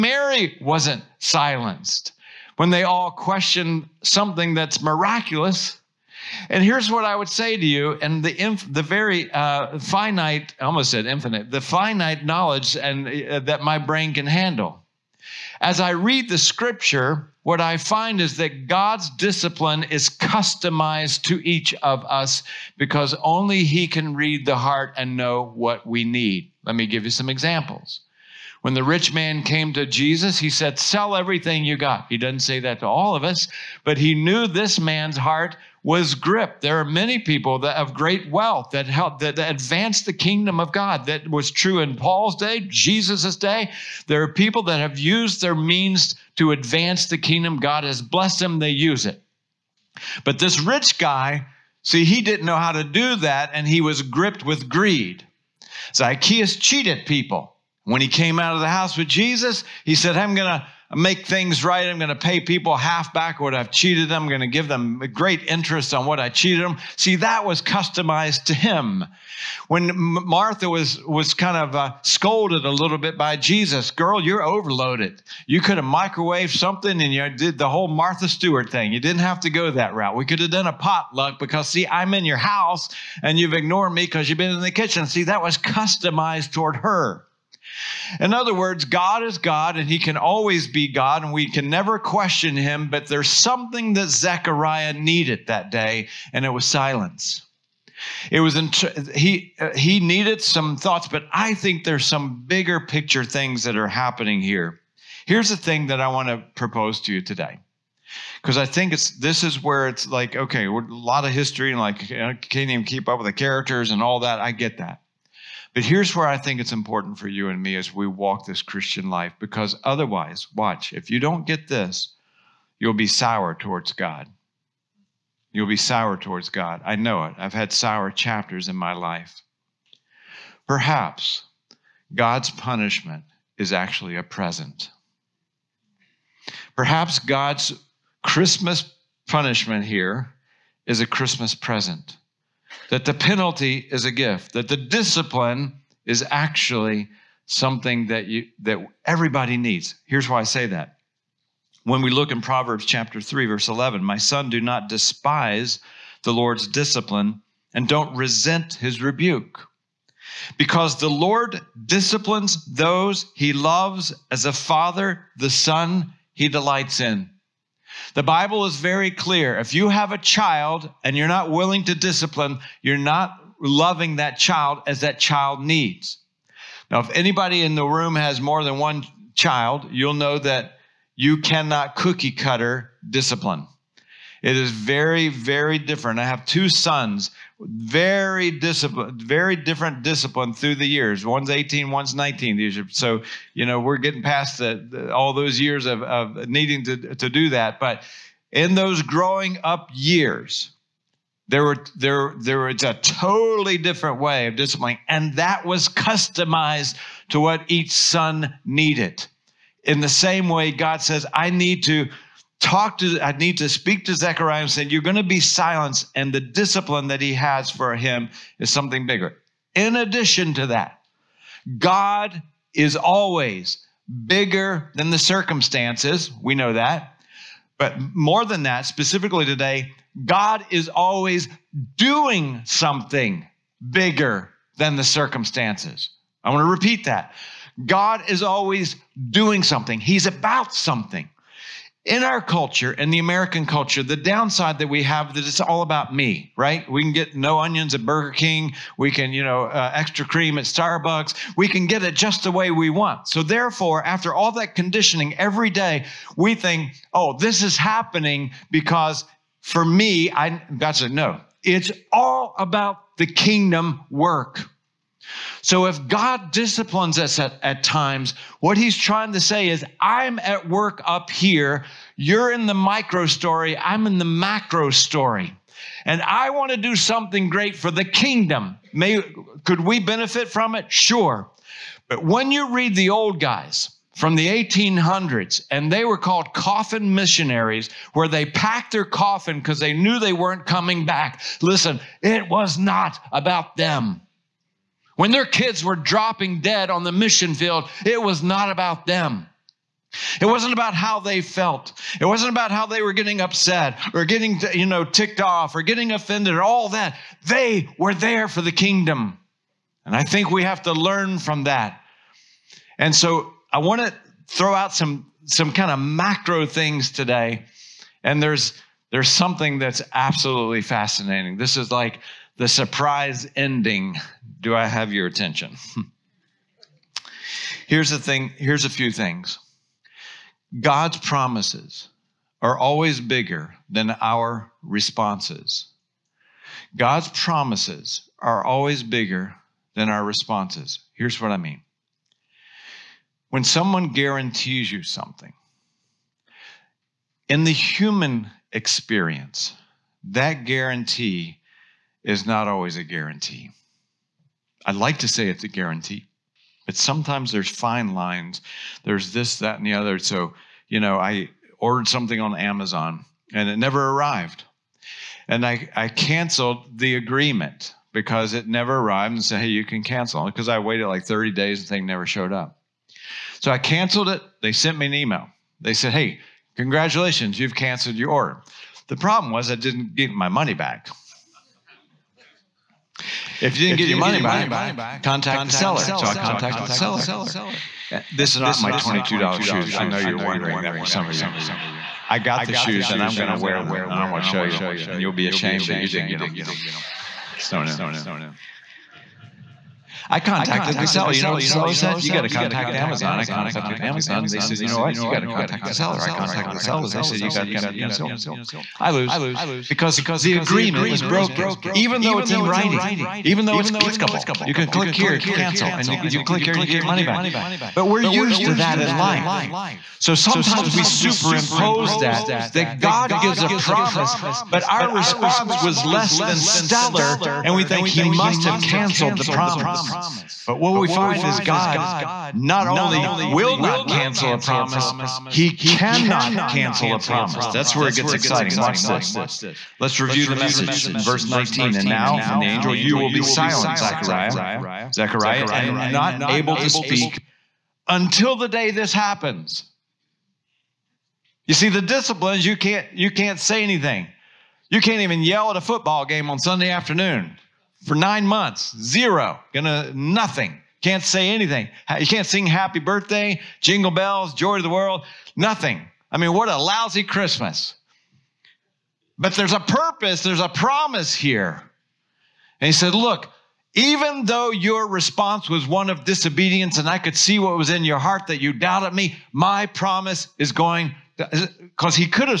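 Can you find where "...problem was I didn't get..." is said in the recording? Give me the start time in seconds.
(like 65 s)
379 s.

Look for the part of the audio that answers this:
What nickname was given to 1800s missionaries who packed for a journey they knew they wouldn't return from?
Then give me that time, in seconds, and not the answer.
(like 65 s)
286 s.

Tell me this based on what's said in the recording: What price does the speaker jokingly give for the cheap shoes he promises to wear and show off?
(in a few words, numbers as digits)
$22.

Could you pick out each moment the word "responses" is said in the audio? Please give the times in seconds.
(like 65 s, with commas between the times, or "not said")
334 s, 340 s, 425 s, 475 s.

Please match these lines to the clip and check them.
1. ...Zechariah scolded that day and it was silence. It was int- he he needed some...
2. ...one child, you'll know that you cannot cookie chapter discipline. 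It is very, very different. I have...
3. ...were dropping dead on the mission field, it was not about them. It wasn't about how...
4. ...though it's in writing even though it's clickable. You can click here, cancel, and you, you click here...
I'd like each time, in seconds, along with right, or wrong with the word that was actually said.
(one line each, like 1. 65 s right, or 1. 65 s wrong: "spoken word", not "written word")
1. 94 s wrong: "needed", not "scolded"
2. 178 s wrong: "cutter", not "chapter"
3. 295 s right
4. 412 s right.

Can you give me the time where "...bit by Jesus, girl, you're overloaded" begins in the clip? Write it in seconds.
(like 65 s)
72 s.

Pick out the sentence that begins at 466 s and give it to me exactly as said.
I mean, what a lousy Christmas.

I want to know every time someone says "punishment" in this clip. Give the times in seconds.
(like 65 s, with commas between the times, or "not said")
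132 s, 139 s.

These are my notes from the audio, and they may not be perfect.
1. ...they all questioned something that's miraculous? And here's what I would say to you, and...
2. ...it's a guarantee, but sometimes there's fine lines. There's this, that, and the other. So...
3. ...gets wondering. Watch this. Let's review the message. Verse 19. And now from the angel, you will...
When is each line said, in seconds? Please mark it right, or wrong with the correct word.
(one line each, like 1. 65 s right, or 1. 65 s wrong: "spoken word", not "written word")
1. 2 s right
2. 355 s right
3. 438 s wrong: "exciting", not "wondering".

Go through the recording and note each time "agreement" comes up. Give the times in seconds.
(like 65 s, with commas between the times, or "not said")
367 s, 410 s.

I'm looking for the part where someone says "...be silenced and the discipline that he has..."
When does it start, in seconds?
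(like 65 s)
215 s.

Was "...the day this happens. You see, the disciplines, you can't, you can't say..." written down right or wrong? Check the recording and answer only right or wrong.
right.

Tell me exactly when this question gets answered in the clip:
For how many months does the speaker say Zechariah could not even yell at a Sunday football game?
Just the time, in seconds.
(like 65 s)
458 s.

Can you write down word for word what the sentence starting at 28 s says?
When the rich man came to Jesus, he said, Sell everything you got.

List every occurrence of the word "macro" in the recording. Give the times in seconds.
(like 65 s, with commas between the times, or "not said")
274 s, 315 s.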